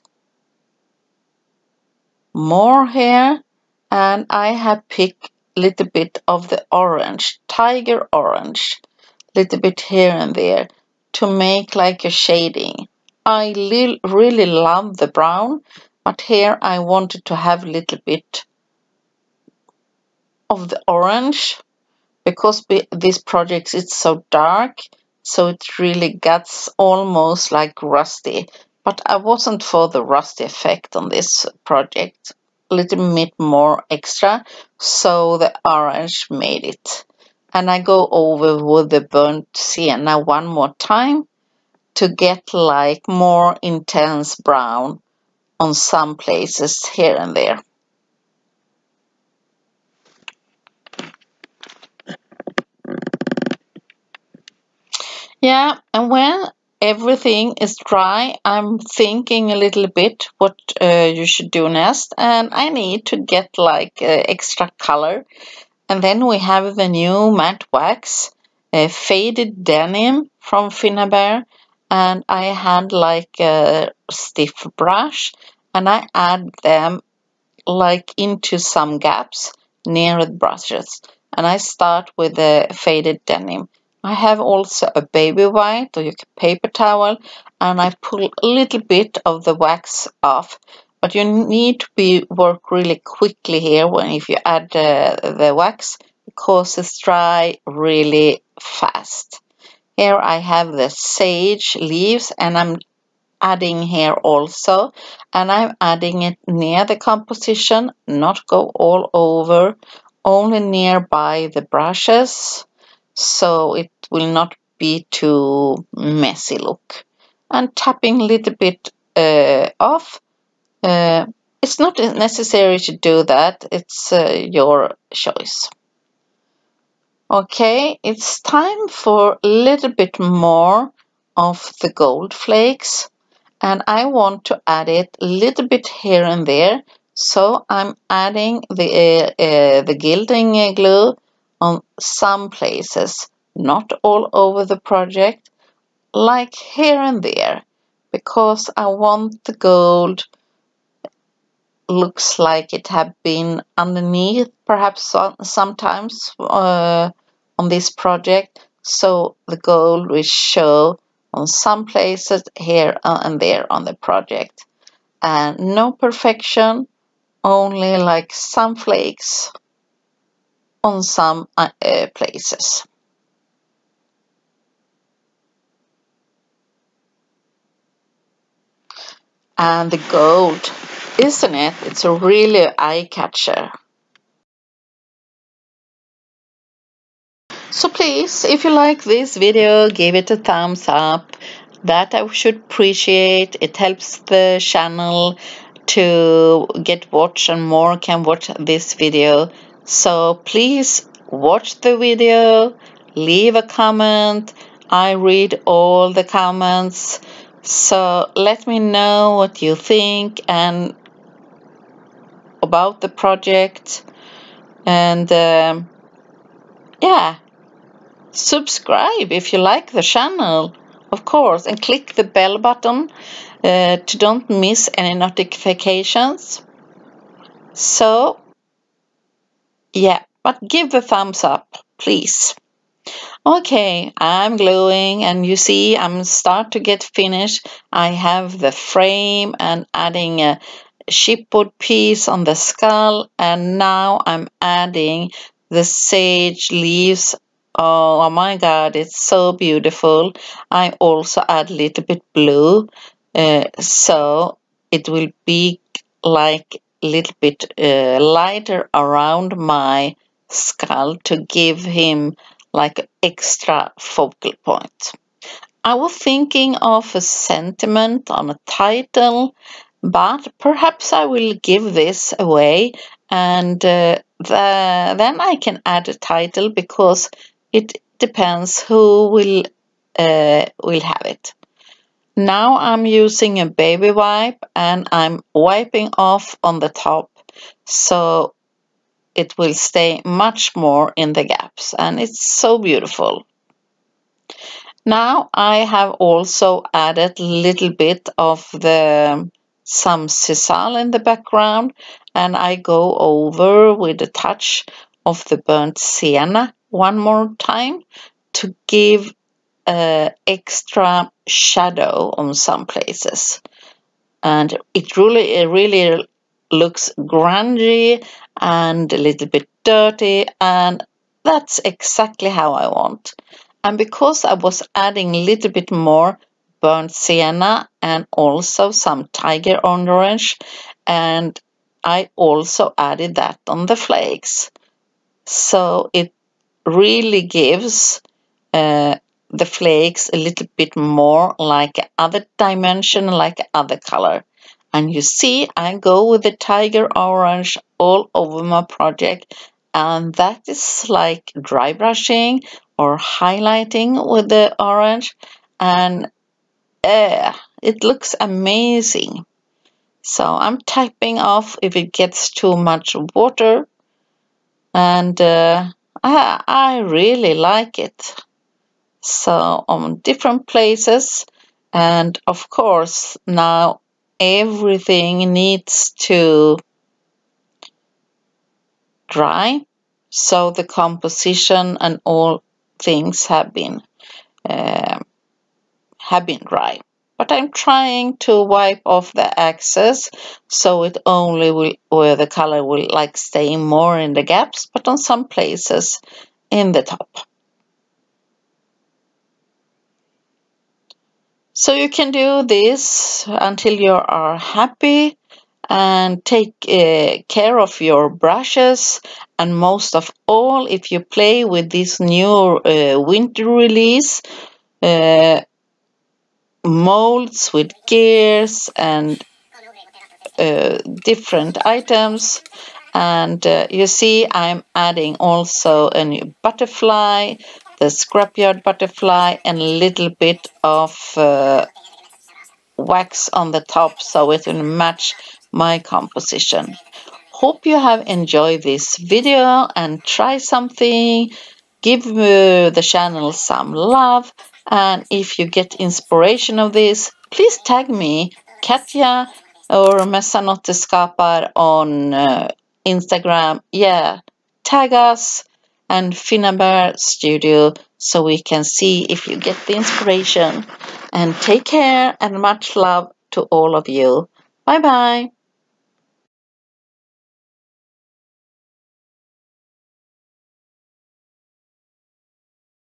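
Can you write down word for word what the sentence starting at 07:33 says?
Yeah, tag us and Finnabair Studio so we can see if you get the inspiration.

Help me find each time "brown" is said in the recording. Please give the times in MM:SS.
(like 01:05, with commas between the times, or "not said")
00:15, 00:44.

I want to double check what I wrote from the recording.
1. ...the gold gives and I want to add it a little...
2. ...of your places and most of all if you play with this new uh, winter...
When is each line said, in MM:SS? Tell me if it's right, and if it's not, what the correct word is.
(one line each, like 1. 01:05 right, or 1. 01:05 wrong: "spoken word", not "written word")
1. 02:11 wrong: "flakes", not "gives"
2. 06:47 wrong: "brushes", not "places".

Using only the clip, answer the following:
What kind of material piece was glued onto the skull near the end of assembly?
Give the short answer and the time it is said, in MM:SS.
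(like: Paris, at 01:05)
Chipboard, at 04:01.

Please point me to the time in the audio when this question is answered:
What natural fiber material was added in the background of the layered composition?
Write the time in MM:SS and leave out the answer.
05:00.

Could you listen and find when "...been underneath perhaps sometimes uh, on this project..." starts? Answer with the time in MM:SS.
02:33.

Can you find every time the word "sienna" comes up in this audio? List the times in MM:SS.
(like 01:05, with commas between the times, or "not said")
00:39, 05:05, 05:27.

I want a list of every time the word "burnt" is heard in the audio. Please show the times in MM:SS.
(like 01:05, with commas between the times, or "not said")
00:39, 05:05, 05:26.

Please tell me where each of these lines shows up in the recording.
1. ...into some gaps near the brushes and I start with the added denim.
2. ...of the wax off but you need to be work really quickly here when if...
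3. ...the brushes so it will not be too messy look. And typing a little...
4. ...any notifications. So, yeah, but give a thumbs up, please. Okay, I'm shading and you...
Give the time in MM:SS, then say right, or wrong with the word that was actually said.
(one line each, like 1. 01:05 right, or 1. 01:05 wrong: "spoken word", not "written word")
1. 01:18 wrong: "faded", not "added"
2. 01:29 right
3. 01:51 wrong: "tapping", not "typing"
4. 03:44 wrong: "gluing", not "shading".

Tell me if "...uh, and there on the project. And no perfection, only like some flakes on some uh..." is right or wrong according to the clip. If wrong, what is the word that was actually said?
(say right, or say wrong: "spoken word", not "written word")
right.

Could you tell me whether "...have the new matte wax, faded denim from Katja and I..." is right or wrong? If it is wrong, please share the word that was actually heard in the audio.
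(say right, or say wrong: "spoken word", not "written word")
wrong: "Finnabair", not "Katja".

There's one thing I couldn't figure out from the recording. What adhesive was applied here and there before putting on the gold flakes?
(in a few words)
Gilding glue.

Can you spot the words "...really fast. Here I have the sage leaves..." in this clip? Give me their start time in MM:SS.
01:37.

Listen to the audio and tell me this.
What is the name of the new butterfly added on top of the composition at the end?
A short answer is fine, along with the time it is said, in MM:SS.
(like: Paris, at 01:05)
Scrapyard butterfly, at 07:08.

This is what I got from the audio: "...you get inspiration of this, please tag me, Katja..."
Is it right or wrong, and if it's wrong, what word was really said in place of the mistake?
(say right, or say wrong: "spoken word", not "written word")
right.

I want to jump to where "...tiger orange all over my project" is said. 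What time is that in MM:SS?
05:46.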